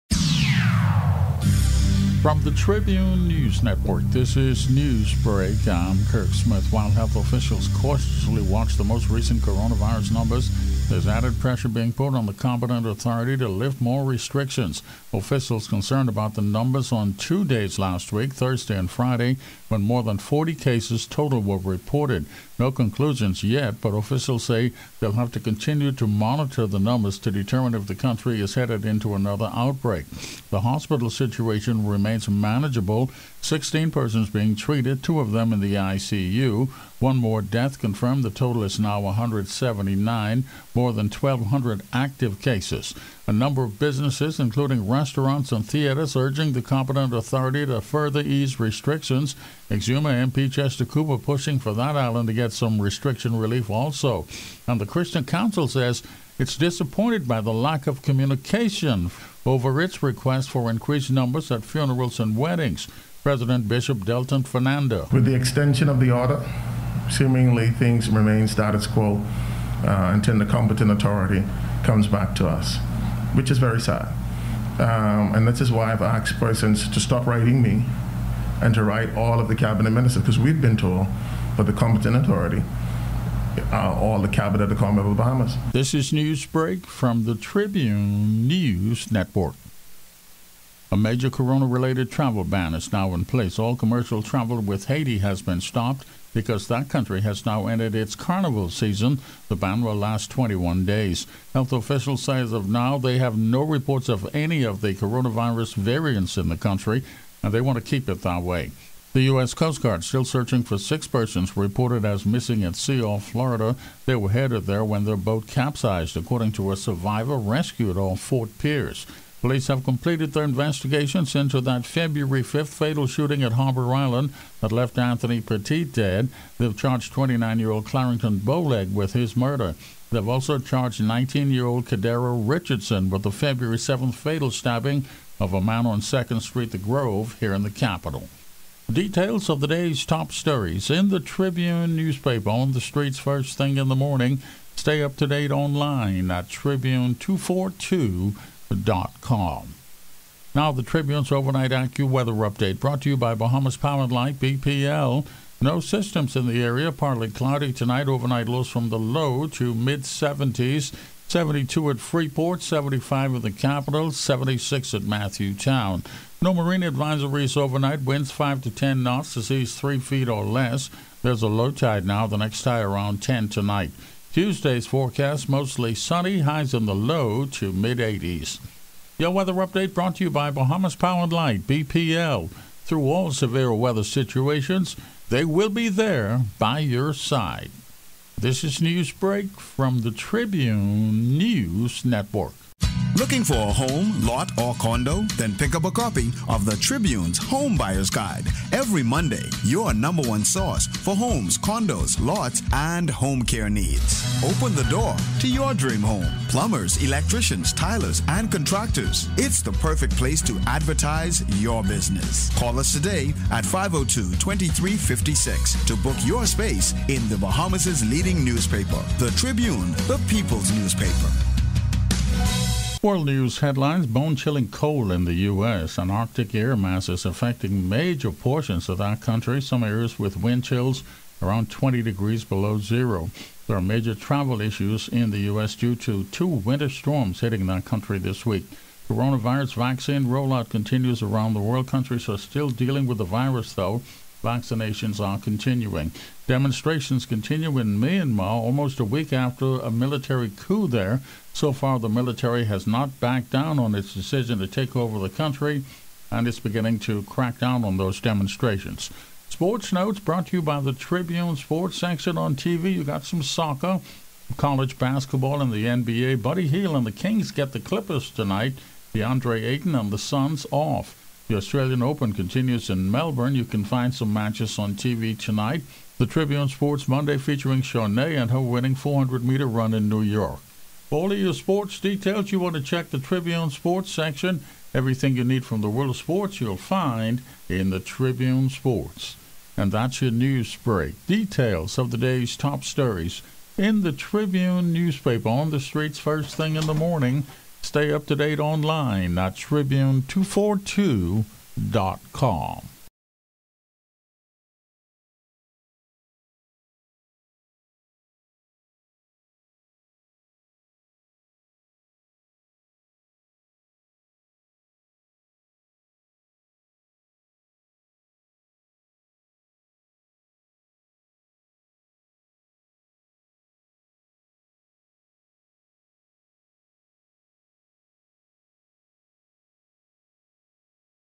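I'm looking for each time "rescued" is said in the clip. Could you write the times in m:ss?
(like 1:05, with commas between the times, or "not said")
1:57.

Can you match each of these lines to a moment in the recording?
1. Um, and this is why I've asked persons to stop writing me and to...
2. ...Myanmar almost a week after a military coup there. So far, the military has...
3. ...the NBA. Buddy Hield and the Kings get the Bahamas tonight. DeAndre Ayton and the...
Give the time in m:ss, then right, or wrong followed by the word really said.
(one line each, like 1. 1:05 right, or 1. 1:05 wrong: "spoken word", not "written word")
1. 1:14 right
2. 4:07 right
3. 4:25 wrong: "Clippers", not "Bahamas".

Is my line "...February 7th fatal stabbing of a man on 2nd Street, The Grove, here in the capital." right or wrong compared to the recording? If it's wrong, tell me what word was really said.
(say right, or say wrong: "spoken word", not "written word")
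right.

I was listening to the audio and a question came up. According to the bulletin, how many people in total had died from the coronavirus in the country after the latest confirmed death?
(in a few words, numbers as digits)
179.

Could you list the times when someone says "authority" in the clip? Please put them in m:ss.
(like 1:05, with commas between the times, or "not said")
0:12, 0:47, 1:10, 1:22.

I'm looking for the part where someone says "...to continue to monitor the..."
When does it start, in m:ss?
0:25.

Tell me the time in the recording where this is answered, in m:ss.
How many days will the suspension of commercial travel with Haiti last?
1:40.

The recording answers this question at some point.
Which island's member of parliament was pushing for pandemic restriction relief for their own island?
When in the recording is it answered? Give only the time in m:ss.
0:49.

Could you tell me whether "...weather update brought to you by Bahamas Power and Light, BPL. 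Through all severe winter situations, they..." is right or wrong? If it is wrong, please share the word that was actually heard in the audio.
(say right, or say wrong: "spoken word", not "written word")
wrong: "weather", not "winter".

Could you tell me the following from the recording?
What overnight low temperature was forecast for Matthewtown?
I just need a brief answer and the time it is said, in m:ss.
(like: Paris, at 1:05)
76, at 2:44.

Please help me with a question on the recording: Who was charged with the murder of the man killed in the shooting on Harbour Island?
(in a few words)
Clarendon Bowleg.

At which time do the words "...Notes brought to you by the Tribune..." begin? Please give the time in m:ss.
4:19.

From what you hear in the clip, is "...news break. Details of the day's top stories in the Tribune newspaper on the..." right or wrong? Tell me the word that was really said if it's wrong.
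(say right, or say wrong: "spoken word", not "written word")
right.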